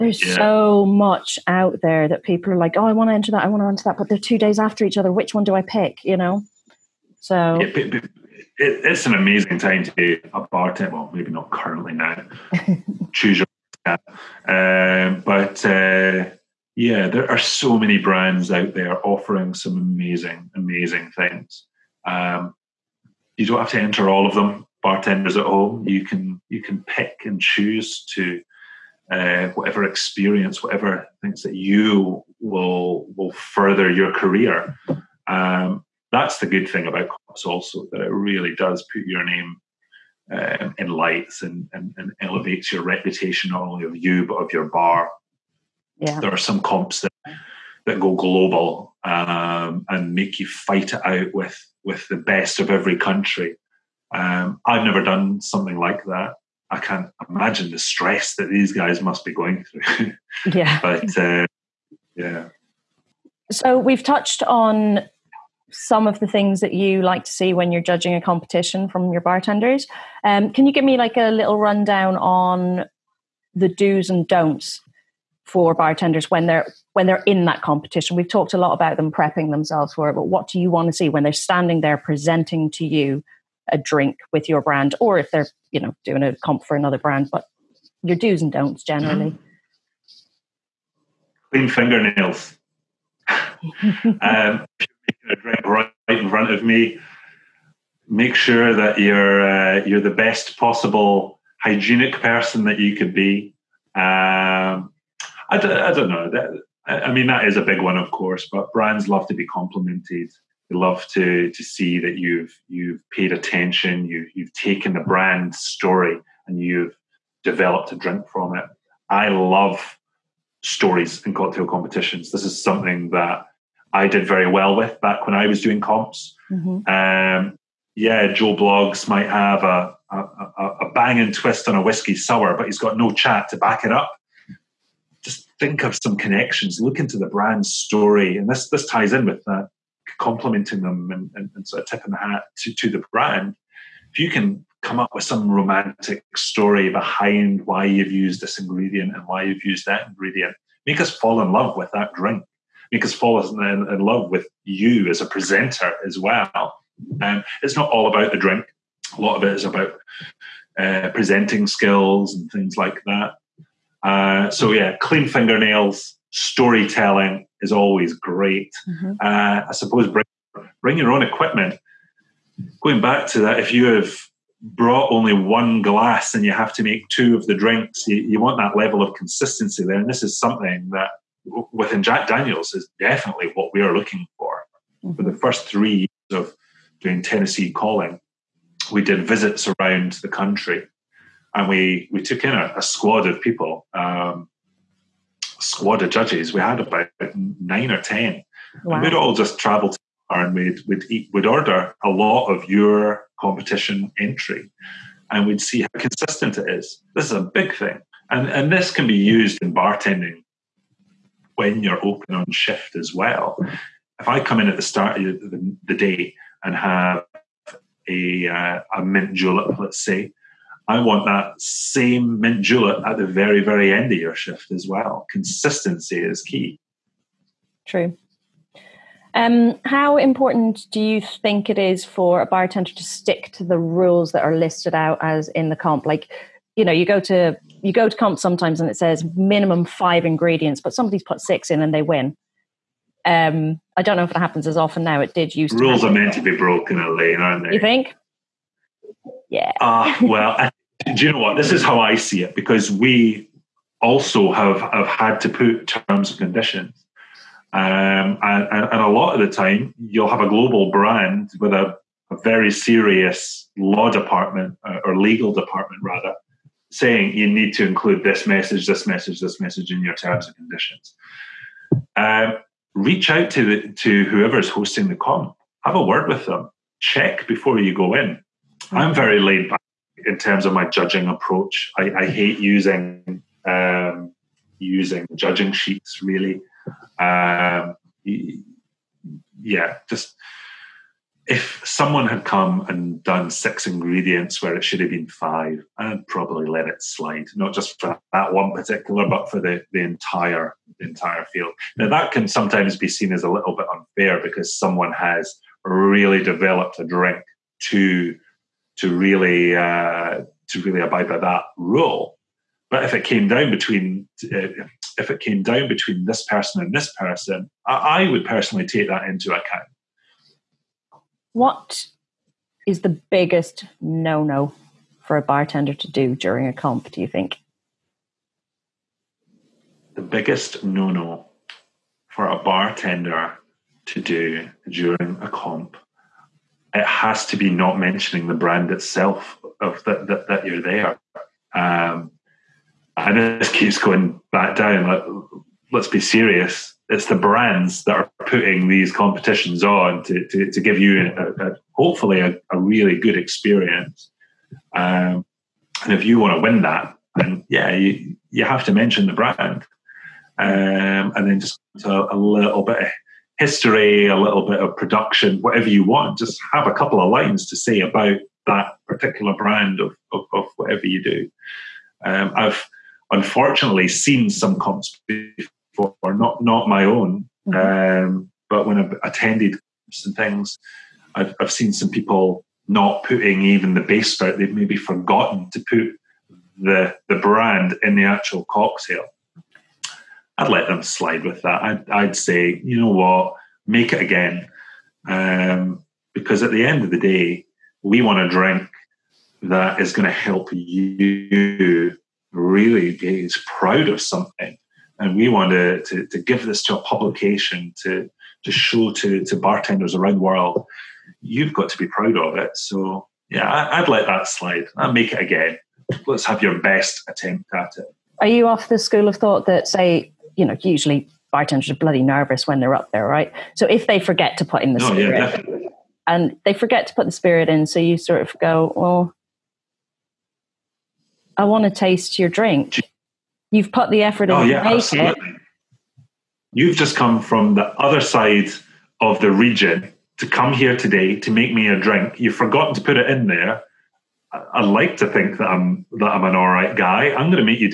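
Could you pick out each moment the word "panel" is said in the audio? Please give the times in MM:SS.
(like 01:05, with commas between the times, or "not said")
not said.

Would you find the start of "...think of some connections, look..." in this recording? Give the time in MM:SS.
02:15.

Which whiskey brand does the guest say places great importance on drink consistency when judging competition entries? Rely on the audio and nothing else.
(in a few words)
Jack Daniels.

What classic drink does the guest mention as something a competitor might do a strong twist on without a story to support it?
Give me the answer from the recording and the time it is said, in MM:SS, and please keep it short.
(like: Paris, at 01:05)
Whiskey sour, at 02:11.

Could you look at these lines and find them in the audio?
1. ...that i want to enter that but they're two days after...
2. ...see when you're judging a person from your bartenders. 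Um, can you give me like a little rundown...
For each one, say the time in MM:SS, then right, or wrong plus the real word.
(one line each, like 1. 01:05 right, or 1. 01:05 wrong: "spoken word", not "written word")
1. 00:03 right
2. 01:07 wrong: "competition", not "person".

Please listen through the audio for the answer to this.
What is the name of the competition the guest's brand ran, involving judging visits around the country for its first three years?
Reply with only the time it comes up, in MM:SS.
03:07.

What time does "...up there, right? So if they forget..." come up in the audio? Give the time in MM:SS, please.
07:02.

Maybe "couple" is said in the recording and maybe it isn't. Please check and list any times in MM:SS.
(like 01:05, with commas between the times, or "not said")
06:06.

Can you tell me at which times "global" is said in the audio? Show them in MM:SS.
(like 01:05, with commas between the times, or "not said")
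00:48, 04:20.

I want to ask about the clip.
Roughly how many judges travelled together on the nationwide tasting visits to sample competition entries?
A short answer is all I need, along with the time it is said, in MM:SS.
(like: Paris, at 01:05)
9 or 10, at 03:16.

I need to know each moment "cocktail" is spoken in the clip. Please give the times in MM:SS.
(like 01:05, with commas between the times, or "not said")
02:01, 06:28.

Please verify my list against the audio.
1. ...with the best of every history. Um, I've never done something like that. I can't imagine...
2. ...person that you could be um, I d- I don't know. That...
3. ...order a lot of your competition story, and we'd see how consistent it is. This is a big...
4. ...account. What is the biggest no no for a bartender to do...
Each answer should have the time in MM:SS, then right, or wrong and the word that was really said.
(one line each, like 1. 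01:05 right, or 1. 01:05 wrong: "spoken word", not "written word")
1. 00:51 wrong: "country", not "history"
2. 01:42 right
3. 03:21 wrong: "entry", not "story"
4. 05:19 right.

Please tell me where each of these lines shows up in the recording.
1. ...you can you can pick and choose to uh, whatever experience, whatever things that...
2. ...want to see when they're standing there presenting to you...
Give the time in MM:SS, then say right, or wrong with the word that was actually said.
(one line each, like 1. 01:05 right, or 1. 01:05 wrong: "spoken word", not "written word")
1. 00:25 right
2. 01:20 right.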